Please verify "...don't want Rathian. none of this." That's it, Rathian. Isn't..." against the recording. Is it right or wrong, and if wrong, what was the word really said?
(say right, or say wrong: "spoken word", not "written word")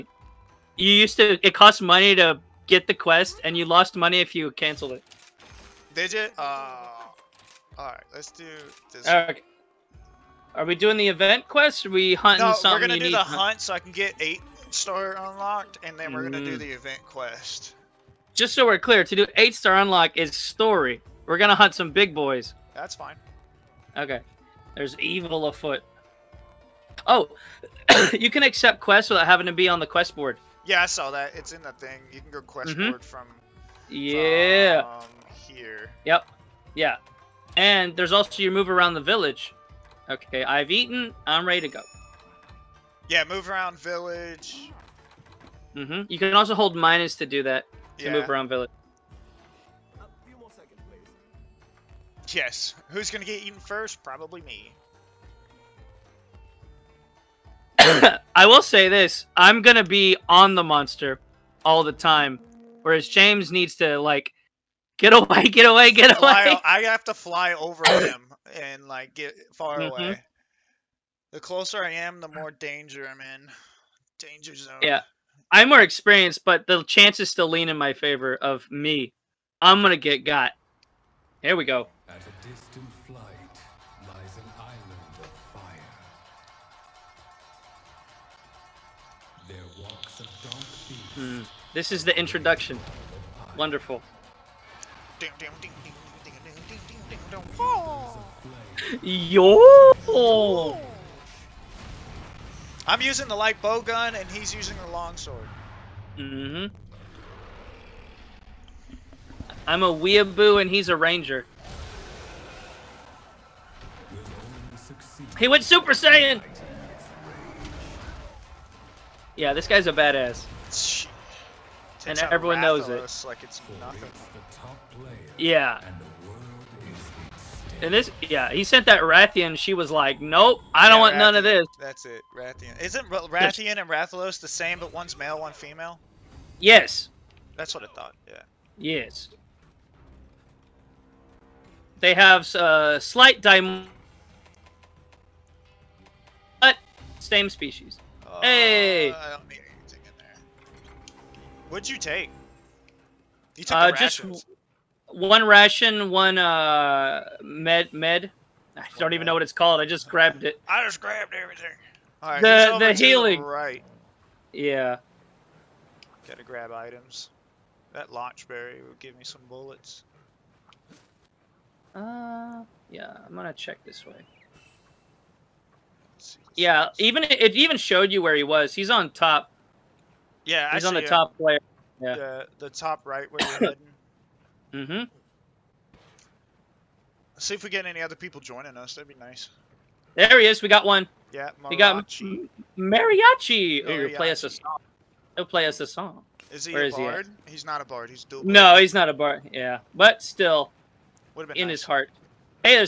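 right.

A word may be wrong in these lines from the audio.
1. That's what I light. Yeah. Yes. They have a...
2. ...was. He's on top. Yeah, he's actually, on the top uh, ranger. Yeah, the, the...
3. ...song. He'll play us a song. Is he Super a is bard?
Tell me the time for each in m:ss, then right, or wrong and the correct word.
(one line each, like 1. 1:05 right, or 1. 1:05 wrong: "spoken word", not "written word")
1. 2:17 wrong: "thought", not "light"
2. 2:58 wrong: "player", not "ranger"
3. 3:14 wrong: "Where", not "Super".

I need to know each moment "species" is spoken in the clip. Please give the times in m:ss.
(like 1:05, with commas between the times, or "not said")
2:27.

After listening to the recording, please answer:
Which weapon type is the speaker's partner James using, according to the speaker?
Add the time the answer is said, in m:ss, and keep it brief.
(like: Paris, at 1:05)
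long sword, at 1:44.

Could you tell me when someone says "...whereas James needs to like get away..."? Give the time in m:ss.
1:02.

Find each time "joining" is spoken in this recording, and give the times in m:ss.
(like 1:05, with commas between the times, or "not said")
3:08.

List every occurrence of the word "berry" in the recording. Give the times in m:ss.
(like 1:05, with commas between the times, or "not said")
2:48.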